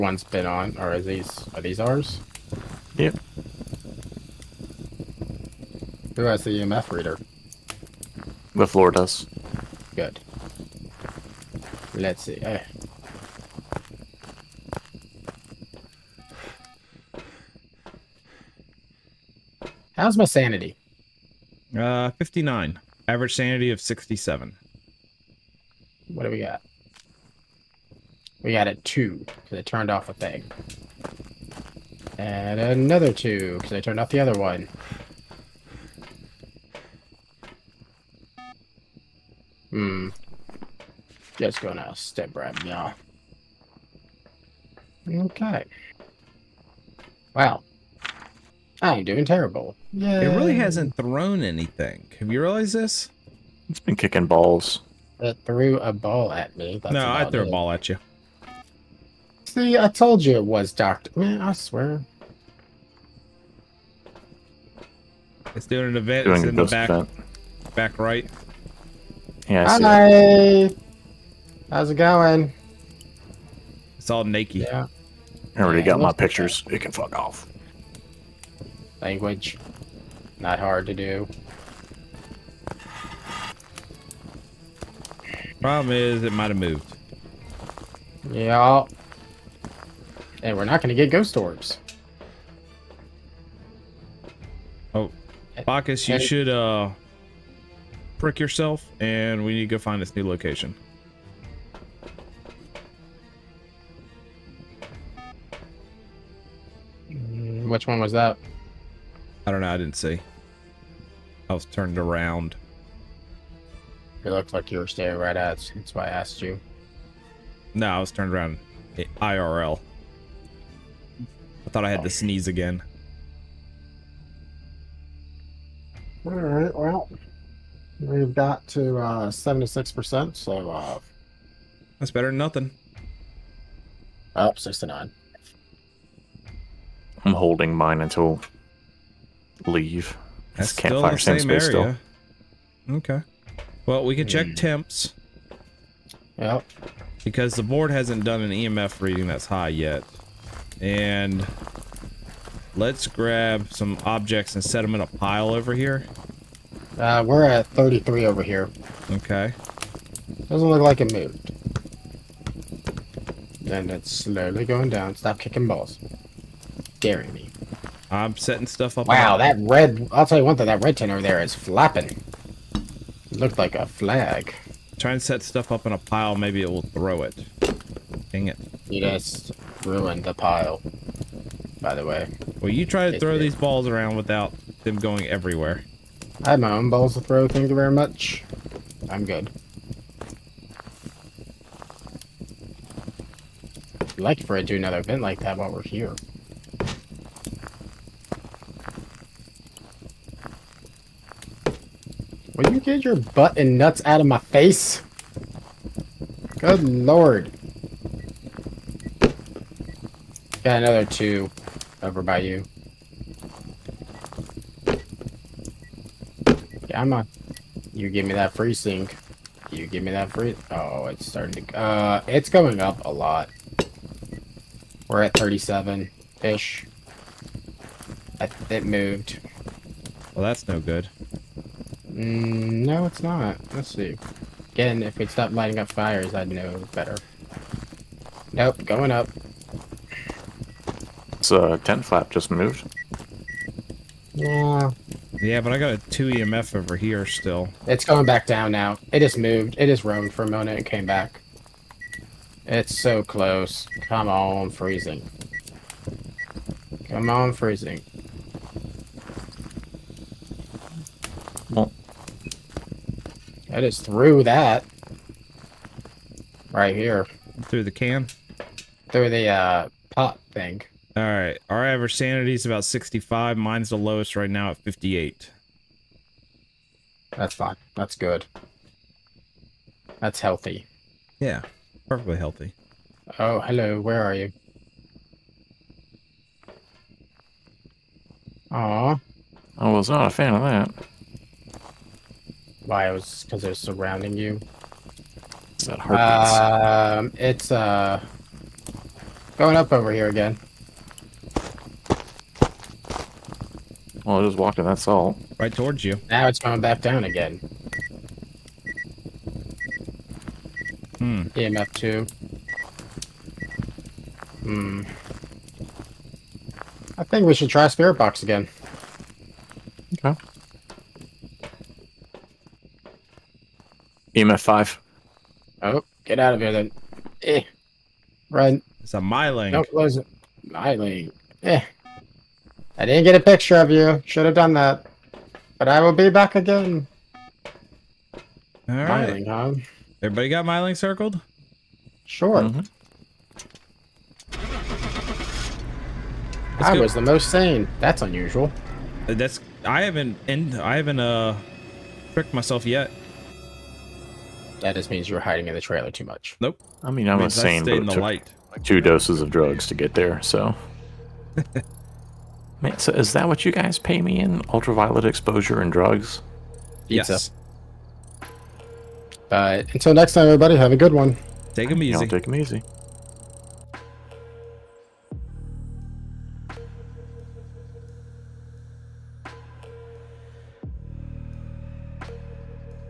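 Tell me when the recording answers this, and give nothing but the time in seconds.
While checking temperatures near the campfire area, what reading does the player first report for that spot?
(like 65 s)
157 s.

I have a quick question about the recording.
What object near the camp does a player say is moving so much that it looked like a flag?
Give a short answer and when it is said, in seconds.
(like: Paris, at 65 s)
red tin, at 170 s.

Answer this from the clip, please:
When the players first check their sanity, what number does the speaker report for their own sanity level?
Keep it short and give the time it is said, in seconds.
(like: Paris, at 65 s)
59, at 22 s.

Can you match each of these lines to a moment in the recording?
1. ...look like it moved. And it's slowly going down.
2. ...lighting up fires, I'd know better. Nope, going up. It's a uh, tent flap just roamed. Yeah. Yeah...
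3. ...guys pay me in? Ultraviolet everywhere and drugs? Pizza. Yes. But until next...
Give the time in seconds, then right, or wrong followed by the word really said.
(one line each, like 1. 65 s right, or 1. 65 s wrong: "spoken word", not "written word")
1. 160 s right
2. 235 s wrong: "moved", not "roamed"
3. 363 s wrong: "exposure", not "everywhere".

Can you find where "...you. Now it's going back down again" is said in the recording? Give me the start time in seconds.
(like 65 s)
306 s.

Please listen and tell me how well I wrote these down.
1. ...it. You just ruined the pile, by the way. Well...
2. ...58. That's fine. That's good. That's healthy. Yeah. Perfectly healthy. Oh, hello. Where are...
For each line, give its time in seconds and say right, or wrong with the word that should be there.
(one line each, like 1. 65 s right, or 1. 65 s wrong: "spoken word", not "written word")
1. 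178 s right
2. 274 s right.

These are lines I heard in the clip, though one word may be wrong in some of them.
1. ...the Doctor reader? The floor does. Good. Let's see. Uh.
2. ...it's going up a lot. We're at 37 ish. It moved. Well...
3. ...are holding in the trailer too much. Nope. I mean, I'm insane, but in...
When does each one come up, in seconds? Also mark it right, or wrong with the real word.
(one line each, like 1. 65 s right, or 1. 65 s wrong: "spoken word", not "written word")
1. 6 s wrong: "EMF", not "Doctor"
2. 222 s right
3. 355 s wrong: "hiding", not "holding".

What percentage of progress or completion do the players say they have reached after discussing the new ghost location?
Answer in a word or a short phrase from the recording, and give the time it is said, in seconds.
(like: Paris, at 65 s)
76%, at 129 s.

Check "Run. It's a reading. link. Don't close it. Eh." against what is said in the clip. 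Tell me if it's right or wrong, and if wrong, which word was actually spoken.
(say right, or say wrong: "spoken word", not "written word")
wrong: "myling", not "reading".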